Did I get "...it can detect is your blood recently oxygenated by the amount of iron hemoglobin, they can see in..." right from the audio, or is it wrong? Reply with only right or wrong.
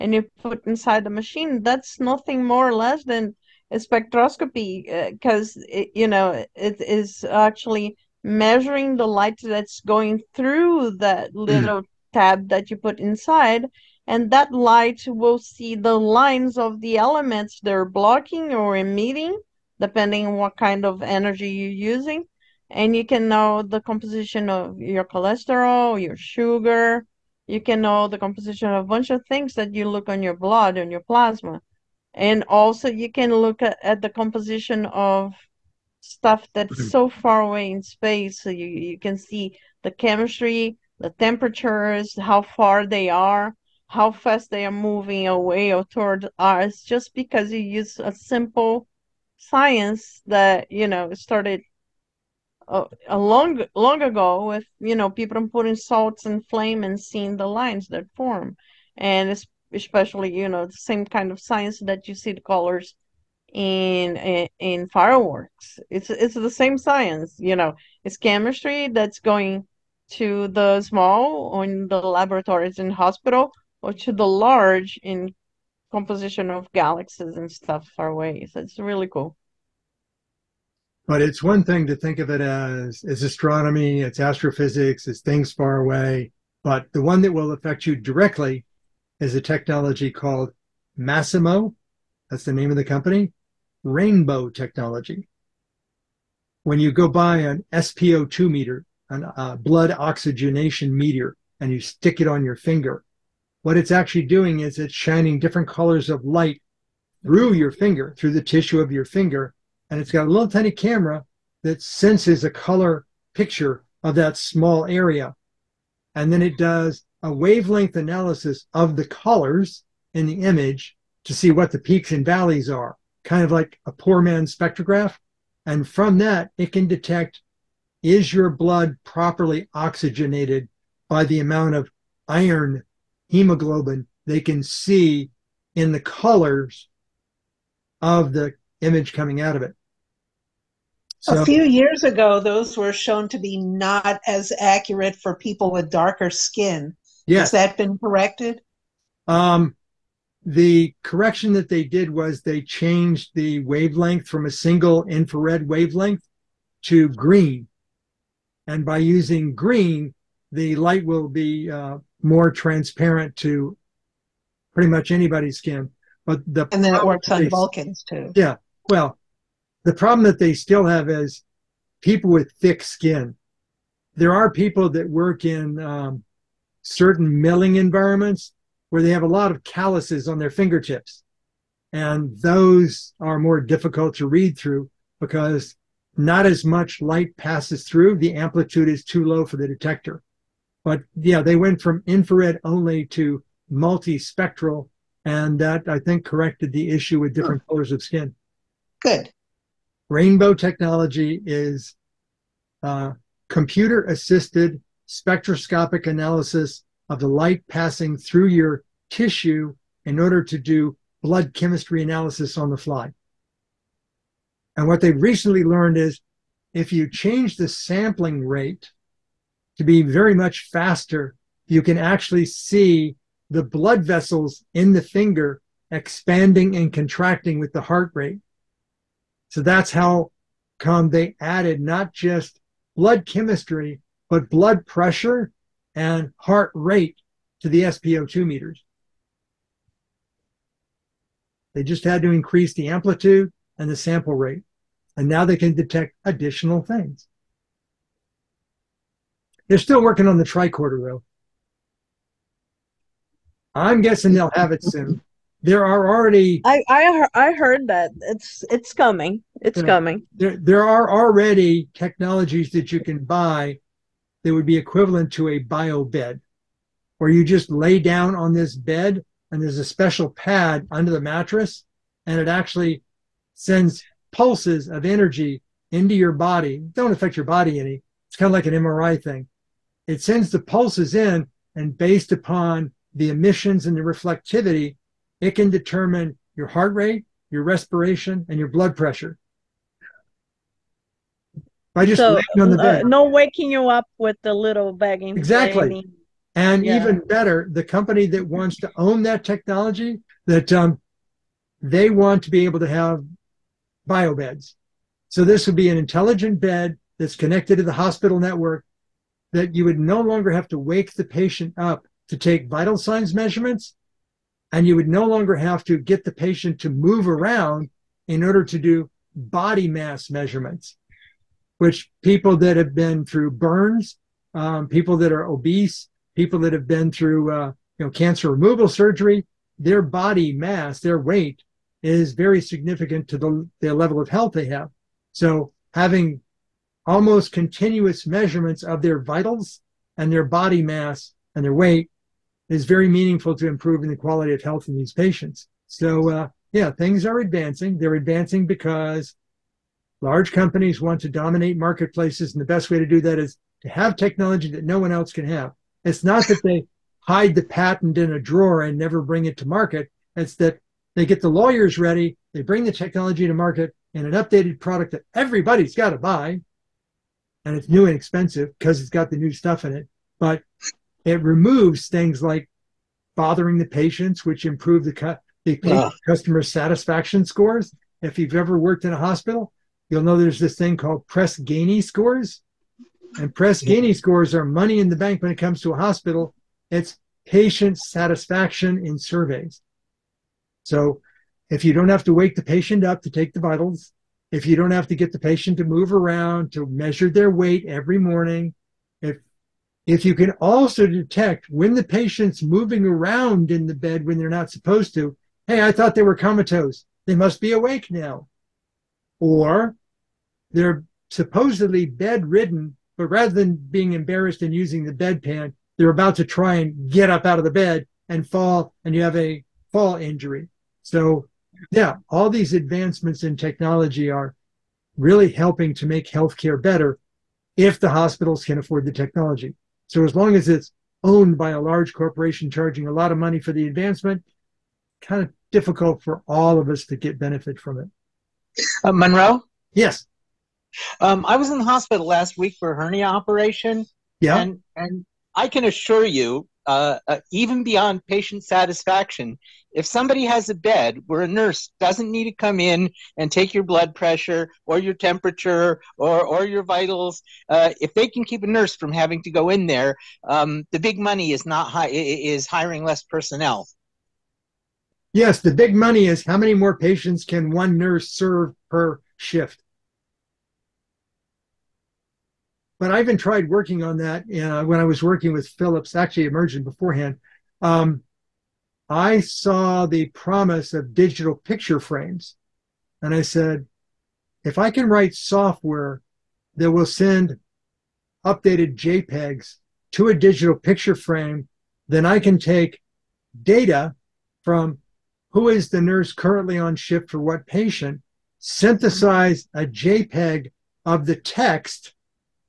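wrong.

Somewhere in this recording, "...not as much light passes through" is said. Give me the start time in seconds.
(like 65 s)
186 s.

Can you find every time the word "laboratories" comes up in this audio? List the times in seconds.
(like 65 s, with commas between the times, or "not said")
72 s.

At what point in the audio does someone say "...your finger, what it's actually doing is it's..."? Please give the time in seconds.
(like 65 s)
102 s.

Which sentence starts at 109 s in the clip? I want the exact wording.
And it's got a little tiny camera that senses a color picture of that small area.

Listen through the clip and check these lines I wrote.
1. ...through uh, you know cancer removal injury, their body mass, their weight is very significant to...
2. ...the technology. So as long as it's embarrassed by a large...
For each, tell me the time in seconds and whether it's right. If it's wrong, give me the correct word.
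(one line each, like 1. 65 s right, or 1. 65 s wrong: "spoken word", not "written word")
1. 327 s wrong: "surgery", not "injury"
2. 429 s wrong: "owned", not "embarrassed".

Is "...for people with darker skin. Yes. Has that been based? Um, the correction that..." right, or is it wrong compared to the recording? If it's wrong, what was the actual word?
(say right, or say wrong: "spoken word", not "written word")
wrong: "corrected", not "based".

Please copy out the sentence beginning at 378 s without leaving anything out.
If you've ever worked in a hospital, you'll know there's this thing called Press Ganey scores.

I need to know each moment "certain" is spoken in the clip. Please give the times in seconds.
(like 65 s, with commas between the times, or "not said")
176 s.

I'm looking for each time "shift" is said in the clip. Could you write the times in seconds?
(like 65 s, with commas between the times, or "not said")
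469 s, 496 s.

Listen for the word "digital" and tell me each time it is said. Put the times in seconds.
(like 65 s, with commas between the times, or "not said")
481 s, 490 s.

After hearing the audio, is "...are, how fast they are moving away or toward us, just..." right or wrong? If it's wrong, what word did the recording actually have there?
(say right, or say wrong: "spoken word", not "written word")
right.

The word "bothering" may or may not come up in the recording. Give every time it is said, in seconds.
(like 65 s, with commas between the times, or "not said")
373 s.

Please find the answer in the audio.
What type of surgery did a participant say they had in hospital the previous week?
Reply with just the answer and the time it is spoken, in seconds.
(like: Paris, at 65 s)
Hernia operation, at 442 s.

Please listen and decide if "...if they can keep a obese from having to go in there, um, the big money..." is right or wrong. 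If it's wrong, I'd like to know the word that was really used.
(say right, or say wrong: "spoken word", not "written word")
wrong: "nurse", not "obese".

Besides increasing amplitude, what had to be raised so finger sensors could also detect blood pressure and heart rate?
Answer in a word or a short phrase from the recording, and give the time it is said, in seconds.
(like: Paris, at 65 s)
Sample rate, at 243 s.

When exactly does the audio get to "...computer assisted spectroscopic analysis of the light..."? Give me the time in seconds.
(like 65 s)
203 s.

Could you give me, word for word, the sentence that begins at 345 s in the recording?
So, uh, yeah, things are advancing.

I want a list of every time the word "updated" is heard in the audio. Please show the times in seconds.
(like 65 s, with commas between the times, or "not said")
364 s, 488 s.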